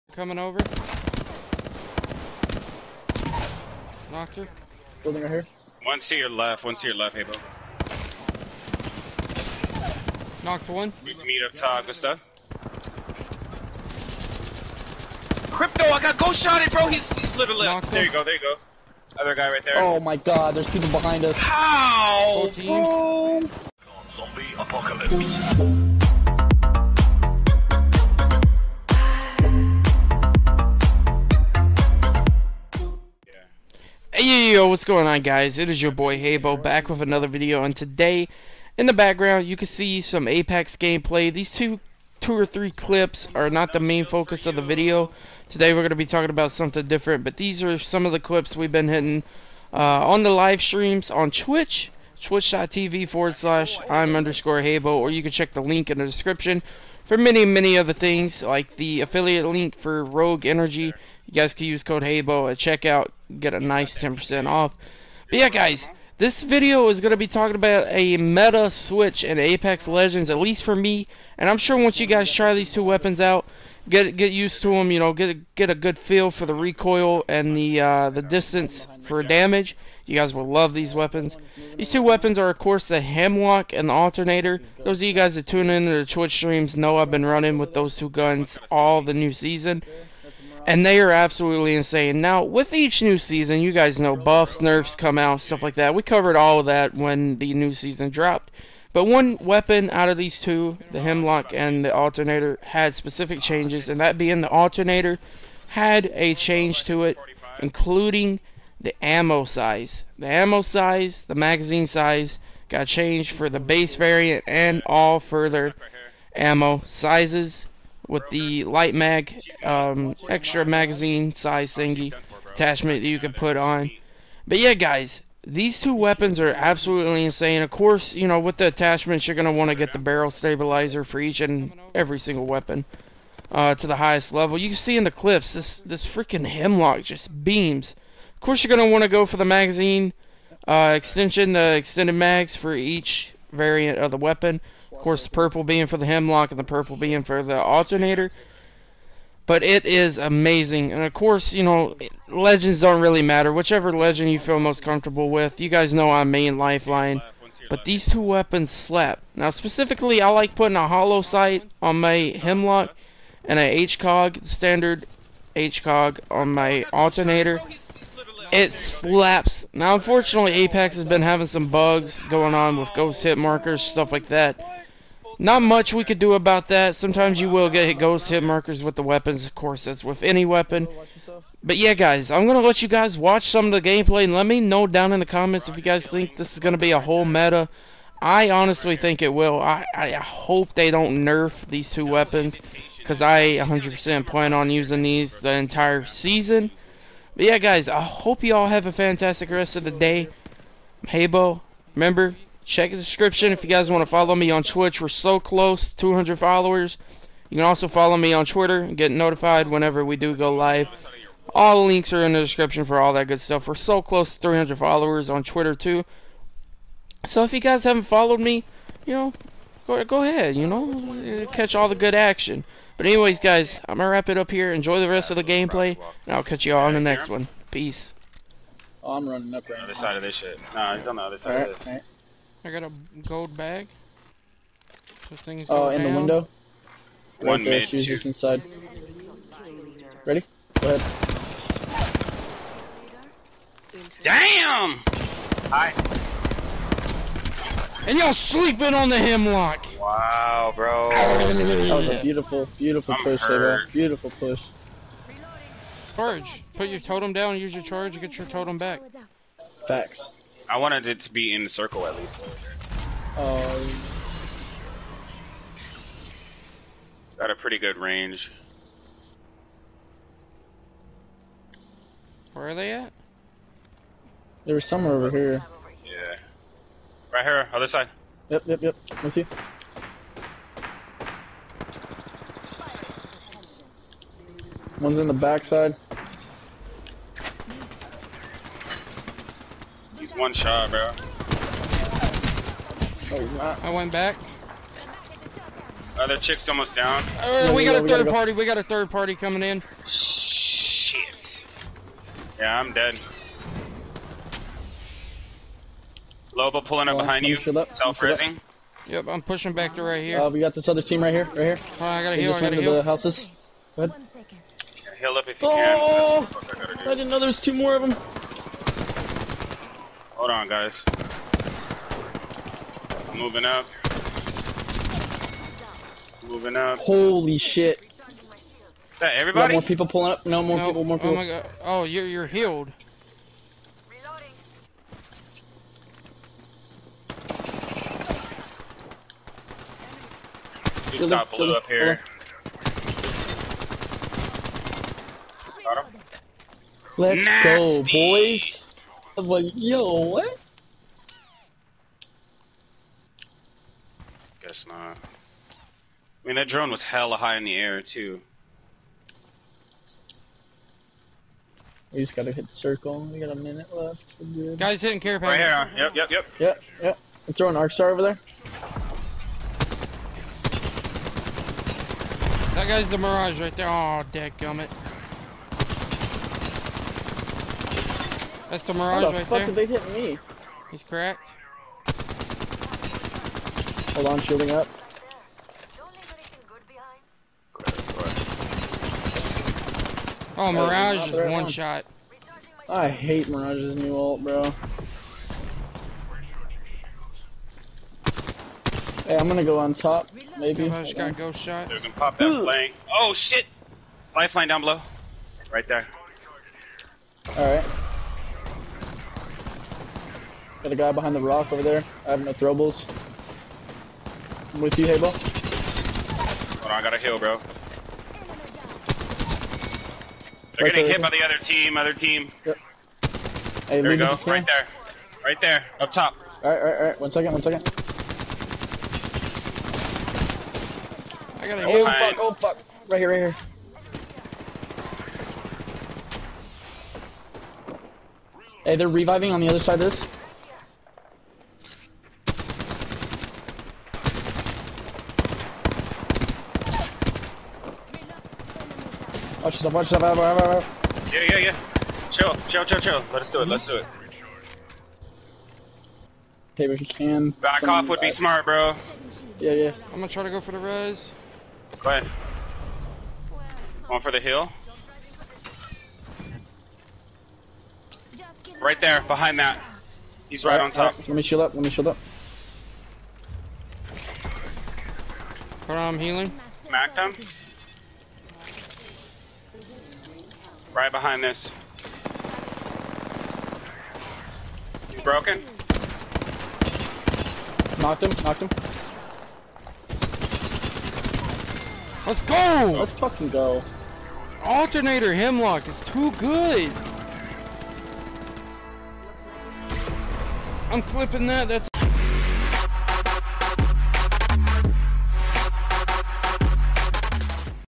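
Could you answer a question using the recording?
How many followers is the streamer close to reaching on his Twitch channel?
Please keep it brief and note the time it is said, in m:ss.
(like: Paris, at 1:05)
200, at 3:25.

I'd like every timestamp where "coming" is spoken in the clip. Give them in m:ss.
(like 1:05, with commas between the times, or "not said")
0:00, 4:59.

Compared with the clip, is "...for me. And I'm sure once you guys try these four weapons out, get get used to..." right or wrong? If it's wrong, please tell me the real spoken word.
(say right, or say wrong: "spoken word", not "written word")
wrong: "two", not "four".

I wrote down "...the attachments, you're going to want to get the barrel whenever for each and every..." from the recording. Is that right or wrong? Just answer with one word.
wrong.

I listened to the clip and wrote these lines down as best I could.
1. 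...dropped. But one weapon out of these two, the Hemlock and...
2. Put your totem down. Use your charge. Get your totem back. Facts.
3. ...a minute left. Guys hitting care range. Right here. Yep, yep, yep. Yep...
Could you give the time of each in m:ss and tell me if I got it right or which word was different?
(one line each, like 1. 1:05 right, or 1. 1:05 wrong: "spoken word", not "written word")
1. 1:38 right
2. 4:16 right
3. 6:03 wrong: "package", not "range".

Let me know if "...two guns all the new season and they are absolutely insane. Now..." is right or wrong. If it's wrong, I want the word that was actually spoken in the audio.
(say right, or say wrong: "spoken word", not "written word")
right.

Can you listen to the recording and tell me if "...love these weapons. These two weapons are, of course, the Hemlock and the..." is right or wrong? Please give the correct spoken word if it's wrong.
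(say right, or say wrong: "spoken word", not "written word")
right.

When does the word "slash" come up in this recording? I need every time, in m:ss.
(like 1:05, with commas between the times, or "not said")
0:53.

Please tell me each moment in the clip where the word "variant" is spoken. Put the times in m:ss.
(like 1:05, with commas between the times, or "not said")
1:53, 2:23.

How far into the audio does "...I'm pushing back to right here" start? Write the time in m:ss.
5:09.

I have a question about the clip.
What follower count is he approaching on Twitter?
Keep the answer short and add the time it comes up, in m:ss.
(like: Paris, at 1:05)
300, at 3:34.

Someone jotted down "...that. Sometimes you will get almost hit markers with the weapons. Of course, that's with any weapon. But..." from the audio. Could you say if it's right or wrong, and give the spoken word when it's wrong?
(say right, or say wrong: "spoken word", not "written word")
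wrong: "ghost", not "almost".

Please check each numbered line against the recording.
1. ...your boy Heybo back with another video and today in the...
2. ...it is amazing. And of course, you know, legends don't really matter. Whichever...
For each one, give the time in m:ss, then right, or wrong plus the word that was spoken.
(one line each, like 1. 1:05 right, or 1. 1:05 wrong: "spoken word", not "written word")
1. 0:35 right
2. 2:29 right.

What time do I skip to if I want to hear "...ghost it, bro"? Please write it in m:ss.
0:16.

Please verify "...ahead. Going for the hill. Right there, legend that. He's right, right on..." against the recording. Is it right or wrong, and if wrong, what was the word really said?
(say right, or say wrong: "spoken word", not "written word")
wrong: "behind", not "legend".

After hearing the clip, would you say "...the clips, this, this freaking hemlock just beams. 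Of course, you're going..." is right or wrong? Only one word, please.
right.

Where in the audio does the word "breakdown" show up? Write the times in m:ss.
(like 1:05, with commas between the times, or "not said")
not said.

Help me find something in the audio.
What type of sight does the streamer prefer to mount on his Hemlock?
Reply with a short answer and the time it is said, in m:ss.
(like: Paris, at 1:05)
holo sight, at 2:40.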